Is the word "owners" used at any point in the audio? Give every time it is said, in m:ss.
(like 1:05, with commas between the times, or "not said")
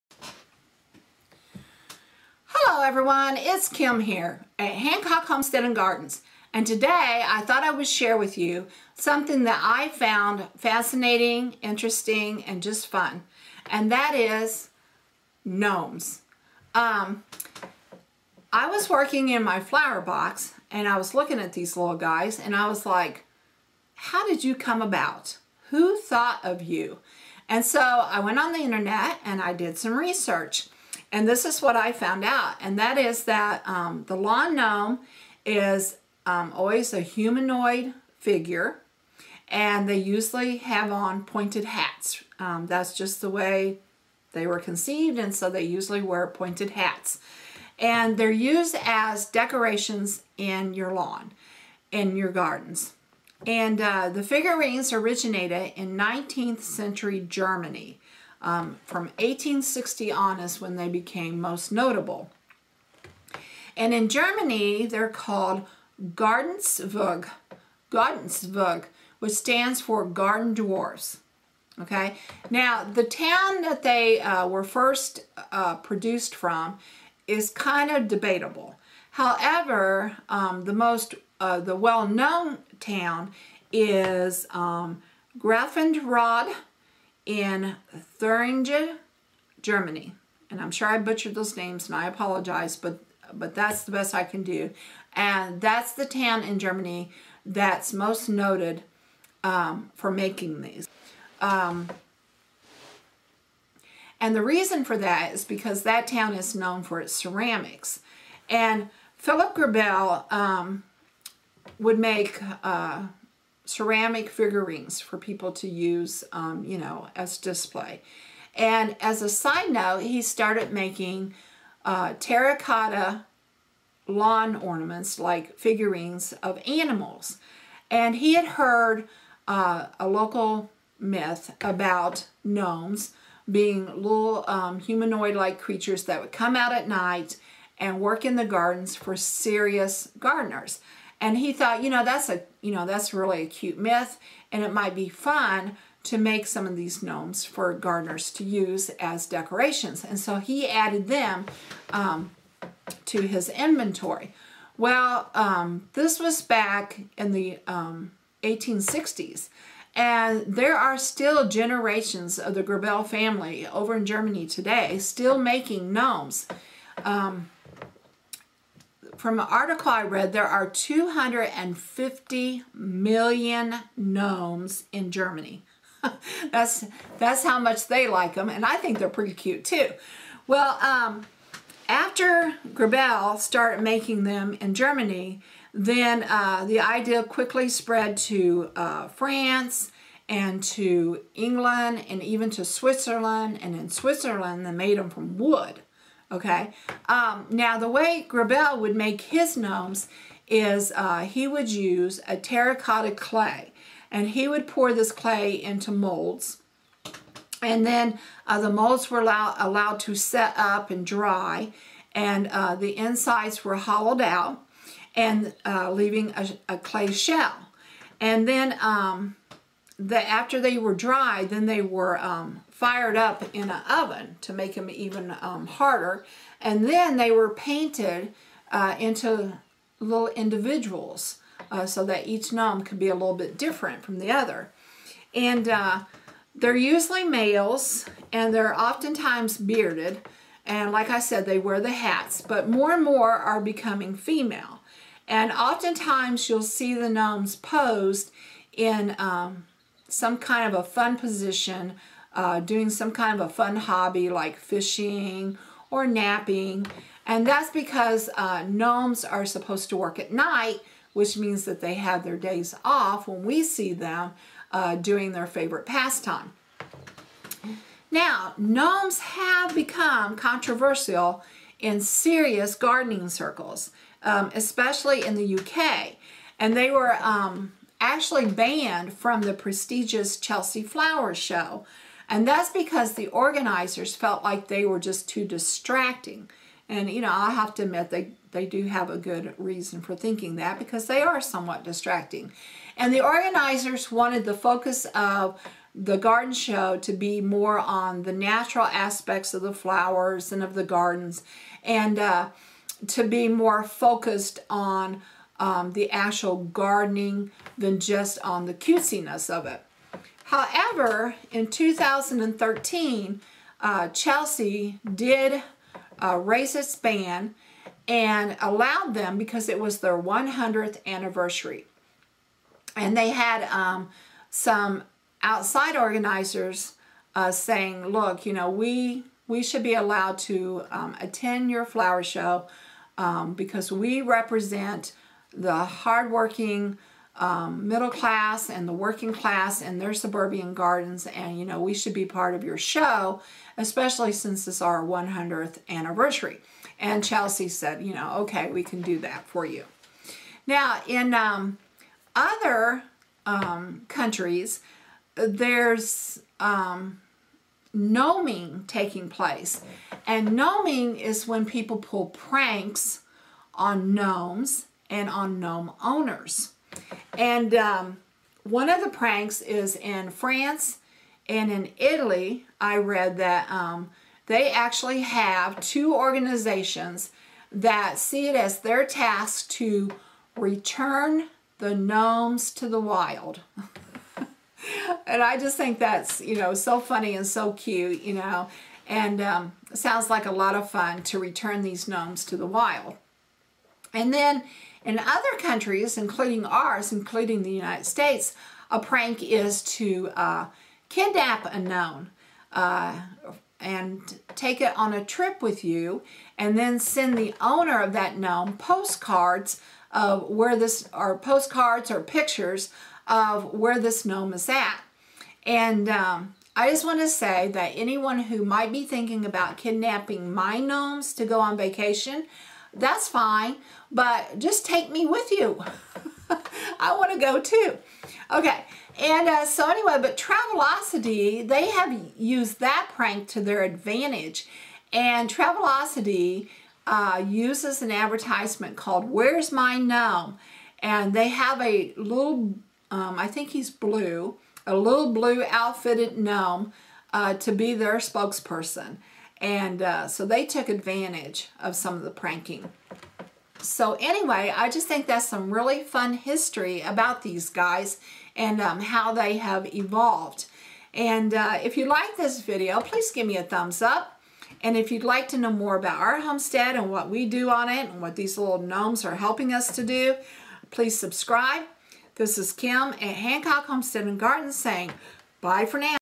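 6:06, 6:47.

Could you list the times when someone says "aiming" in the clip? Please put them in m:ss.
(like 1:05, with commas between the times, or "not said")
not said.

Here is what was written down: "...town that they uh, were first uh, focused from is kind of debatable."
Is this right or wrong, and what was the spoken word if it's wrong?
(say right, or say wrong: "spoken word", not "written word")
wrong: "produced", not "focused".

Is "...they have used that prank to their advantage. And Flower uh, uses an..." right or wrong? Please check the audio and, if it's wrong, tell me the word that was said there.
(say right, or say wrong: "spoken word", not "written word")
wrong: "Travelocity", not "Flower".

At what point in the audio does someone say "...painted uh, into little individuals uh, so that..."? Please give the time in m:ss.
3:47.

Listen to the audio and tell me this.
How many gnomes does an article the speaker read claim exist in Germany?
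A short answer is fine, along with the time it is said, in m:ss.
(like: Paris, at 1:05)
250 million, at 2:50.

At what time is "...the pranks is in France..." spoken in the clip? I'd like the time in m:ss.
6:09.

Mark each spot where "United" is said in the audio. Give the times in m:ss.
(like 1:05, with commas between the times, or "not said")
6:37.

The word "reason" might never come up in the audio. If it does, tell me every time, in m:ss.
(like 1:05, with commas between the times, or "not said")
1:44, 4:49.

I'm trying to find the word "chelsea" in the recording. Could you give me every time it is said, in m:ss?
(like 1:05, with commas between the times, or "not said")
4:40, 5:14, 5:47.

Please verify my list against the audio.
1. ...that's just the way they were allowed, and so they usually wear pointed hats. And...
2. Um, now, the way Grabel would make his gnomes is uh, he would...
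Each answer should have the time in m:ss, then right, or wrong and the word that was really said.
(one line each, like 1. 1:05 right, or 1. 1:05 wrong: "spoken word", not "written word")
1. 0:42 wrong: "conceived", not "allowed"
2. 3:17 right.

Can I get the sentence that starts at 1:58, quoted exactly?
And as a side note, he started making uh, terracotta lawn ornaments, like figurines of animals.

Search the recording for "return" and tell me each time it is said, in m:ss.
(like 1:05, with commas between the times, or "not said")
6:20, 6:31.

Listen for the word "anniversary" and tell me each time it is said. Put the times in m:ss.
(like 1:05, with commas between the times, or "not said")
5:21, 5:45.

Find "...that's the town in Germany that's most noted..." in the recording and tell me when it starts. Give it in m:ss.
1:35.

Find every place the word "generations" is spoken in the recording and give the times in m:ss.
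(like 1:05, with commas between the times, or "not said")
2:41.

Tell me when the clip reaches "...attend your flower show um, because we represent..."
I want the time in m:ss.
5:31.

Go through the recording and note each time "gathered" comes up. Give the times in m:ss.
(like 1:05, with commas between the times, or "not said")
not said.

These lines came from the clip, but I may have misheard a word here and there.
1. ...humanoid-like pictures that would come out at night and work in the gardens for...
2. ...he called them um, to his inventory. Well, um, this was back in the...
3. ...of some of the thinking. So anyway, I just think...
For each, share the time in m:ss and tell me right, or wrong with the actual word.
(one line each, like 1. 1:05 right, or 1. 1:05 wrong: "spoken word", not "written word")
1. 2:14 wrong: "creatures", not "pictures"
2. 2:30 wrong: "added", not "called"
3. 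7:31 wrong: "pranking", not "thinking".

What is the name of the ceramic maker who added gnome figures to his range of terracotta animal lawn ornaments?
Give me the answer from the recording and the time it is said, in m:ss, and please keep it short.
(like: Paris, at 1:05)
Philip Grabel, at 1:49.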